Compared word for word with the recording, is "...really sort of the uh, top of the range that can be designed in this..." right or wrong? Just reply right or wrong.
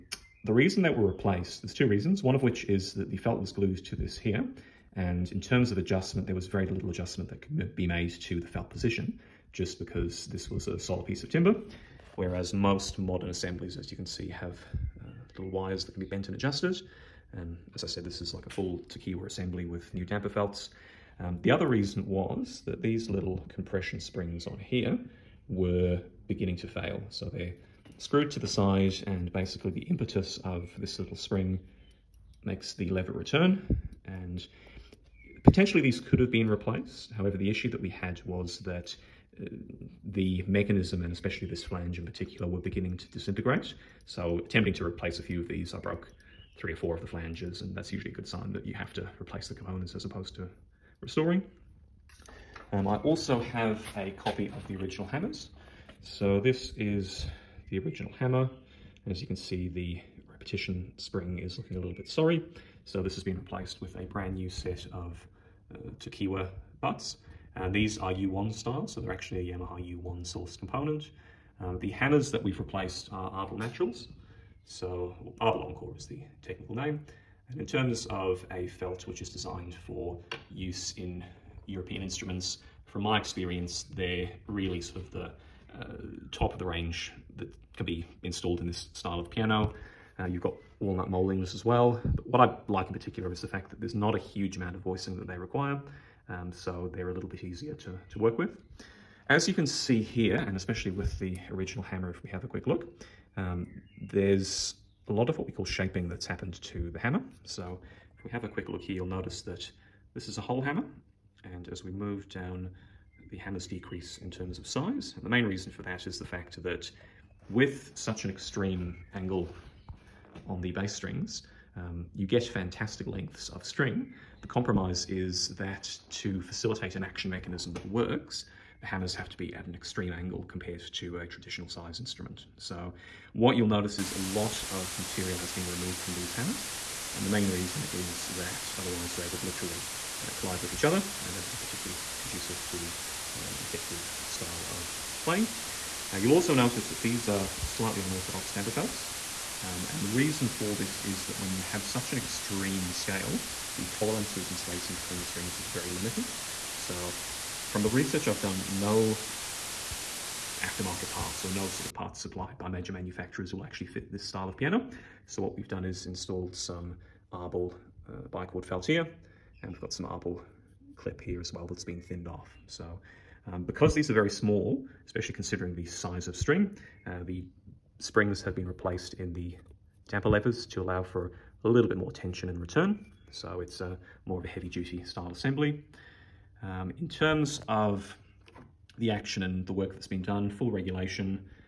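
wrong.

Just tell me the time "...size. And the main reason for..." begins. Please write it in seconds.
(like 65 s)
114 s.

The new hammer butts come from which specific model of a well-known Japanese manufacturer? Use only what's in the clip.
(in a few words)
Yamaha U1.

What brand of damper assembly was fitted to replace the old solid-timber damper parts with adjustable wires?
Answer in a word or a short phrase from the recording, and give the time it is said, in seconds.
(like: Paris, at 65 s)
Tokiwa, at 18 s.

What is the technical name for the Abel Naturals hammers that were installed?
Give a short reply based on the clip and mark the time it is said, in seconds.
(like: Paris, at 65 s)
Abel Encore, at 75 s.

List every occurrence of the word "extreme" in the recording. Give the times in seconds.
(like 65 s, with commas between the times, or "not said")
118 s, 129 s, 152 s.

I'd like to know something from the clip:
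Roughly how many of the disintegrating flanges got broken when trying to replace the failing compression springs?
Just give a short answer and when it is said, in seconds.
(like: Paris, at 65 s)
3 or 4, at 46 s.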